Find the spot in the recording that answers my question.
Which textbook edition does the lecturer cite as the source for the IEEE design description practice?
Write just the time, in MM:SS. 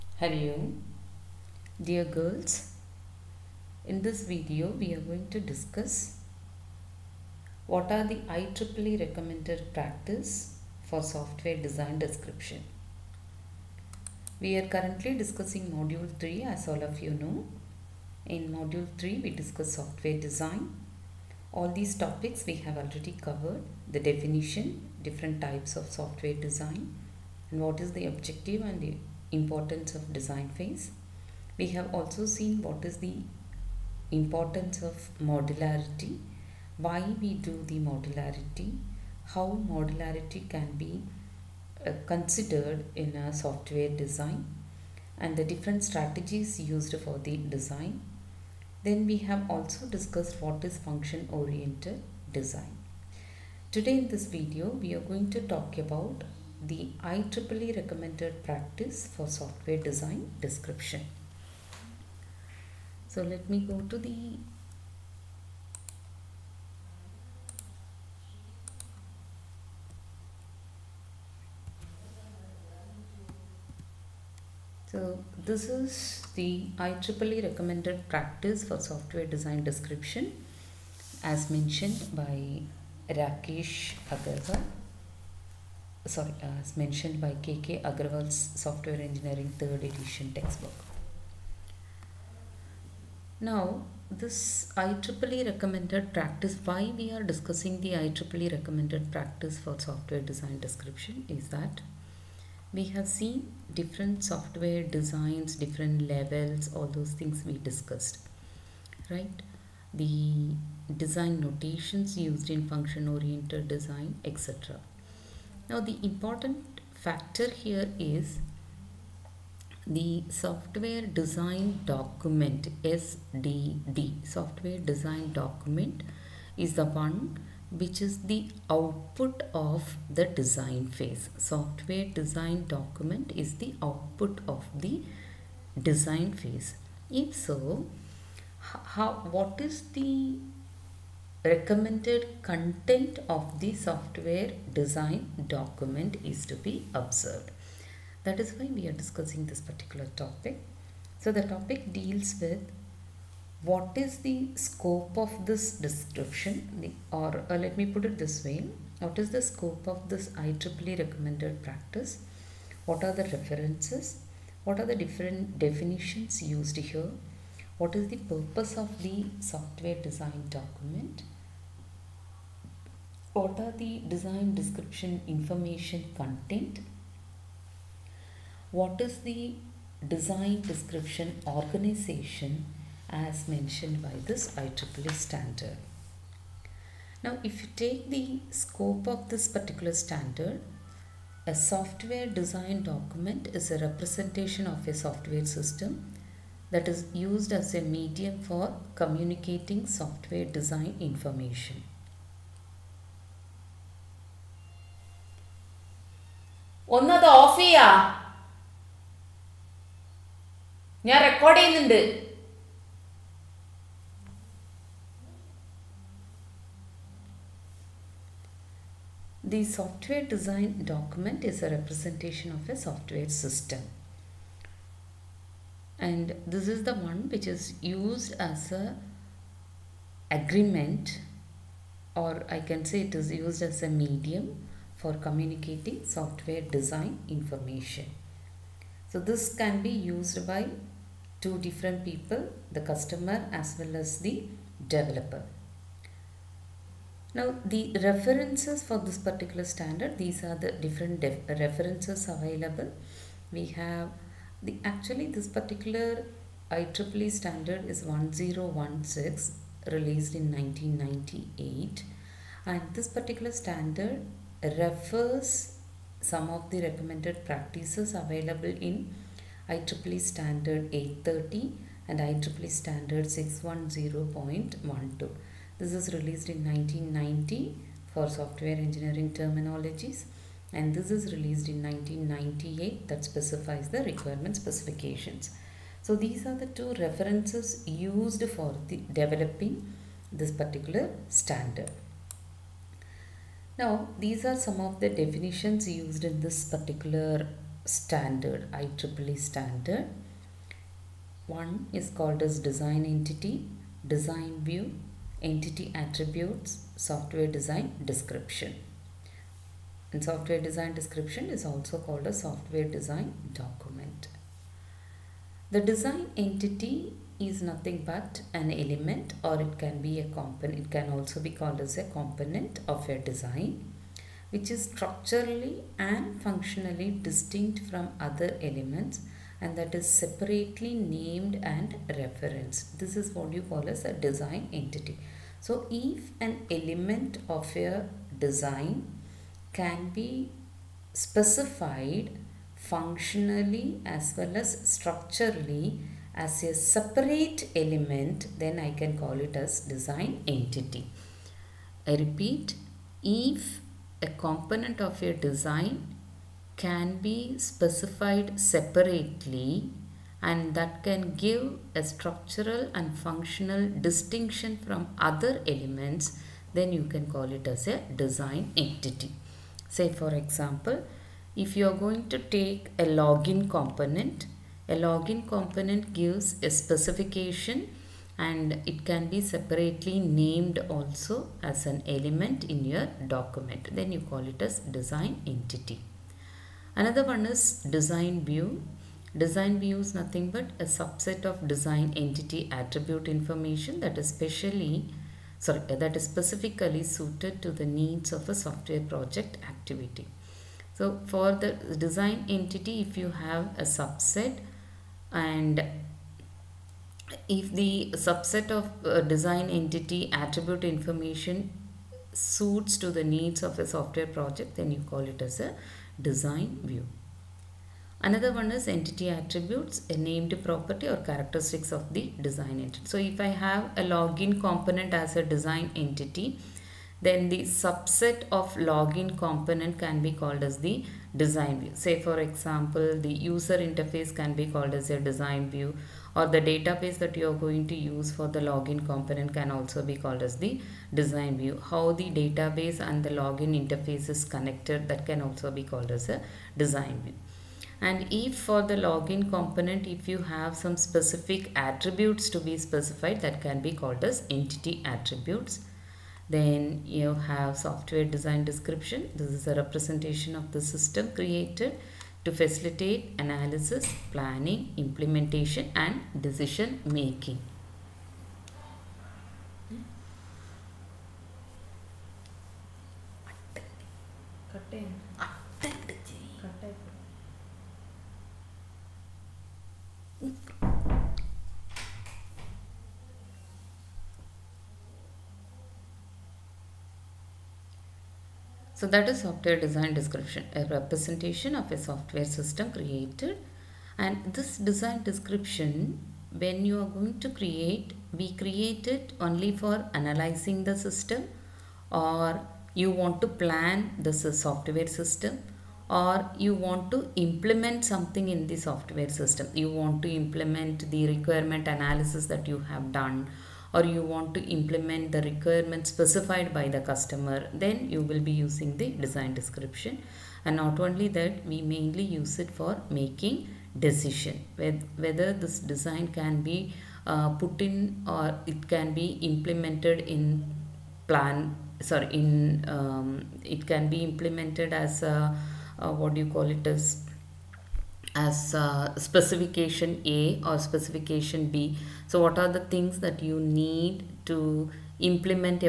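01:29.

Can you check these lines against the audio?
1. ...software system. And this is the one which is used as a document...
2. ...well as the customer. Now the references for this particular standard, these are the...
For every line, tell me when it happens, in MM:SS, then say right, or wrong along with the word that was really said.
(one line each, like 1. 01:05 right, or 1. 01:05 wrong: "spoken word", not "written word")
1. 03:42 wrong: "agreement", not "document"
2. 04:03 wrong: "developer", not "customer".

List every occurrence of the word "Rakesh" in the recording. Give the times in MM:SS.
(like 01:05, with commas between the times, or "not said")
01:23.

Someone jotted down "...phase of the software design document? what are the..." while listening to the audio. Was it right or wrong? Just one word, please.
wrong.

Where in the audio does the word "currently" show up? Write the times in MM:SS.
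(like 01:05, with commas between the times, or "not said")
00:14.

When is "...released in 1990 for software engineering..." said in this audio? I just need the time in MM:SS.
04:36.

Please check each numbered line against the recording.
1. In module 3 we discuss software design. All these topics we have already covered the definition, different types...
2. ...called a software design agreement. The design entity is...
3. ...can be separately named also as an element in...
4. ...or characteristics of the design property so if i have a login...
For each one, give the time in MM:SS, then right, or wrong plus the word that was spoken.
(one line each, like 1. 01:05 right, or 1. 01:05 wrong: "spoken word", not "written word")
1. 00:18 right
2. 05:11 wrong: "document", not "agreement"
3. 06:19 right
4. 07:01 wrong: "entity", not "property".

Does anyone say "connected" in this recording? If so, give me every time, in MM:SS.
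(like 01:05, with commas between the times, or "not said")
07:24.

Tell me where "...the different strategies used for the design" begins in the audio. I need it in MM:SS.
00:45.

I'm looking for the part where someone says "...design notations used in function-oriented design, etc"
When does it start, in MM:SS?
01:50.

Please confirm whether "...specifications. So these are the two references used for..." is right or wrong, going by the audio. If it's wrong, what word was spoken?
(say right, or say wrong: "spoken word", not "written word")
right.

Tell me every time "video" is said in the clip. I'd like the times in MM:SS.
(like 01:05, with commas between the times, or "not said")
00:04, 00:54.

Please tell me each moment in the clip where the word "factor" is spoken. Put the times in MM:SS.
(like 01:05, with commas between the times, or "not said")
01:56.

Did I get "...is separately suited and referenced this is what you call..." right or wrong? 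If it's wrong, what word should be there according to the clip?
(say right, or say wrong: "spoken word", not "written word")
wrong: "named", not "suited".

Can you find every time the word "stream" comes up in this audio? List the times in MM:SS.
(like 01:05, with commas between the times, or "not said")
not said.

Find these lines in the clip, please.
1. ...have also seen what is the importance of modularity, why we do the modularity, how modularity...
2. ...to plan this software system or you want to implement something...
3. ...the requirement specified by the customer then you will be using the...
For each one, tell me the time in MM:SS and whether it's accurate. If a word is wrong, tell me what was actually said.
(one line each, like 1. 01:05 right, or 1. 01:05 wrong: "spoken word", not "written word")
1. 00:31 right
2. 08:23 right
3. 08:35 right.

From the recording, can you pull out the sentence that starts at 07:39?
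This is a representation of the system created to facilitate analysis, planning, implementation and decision making.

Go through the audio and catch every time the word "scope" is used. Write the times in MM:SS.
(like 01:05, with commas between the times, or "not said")
02:34, 02:39, 03:08.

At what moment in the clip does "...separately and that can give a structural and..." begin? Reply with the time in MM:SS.
05:58.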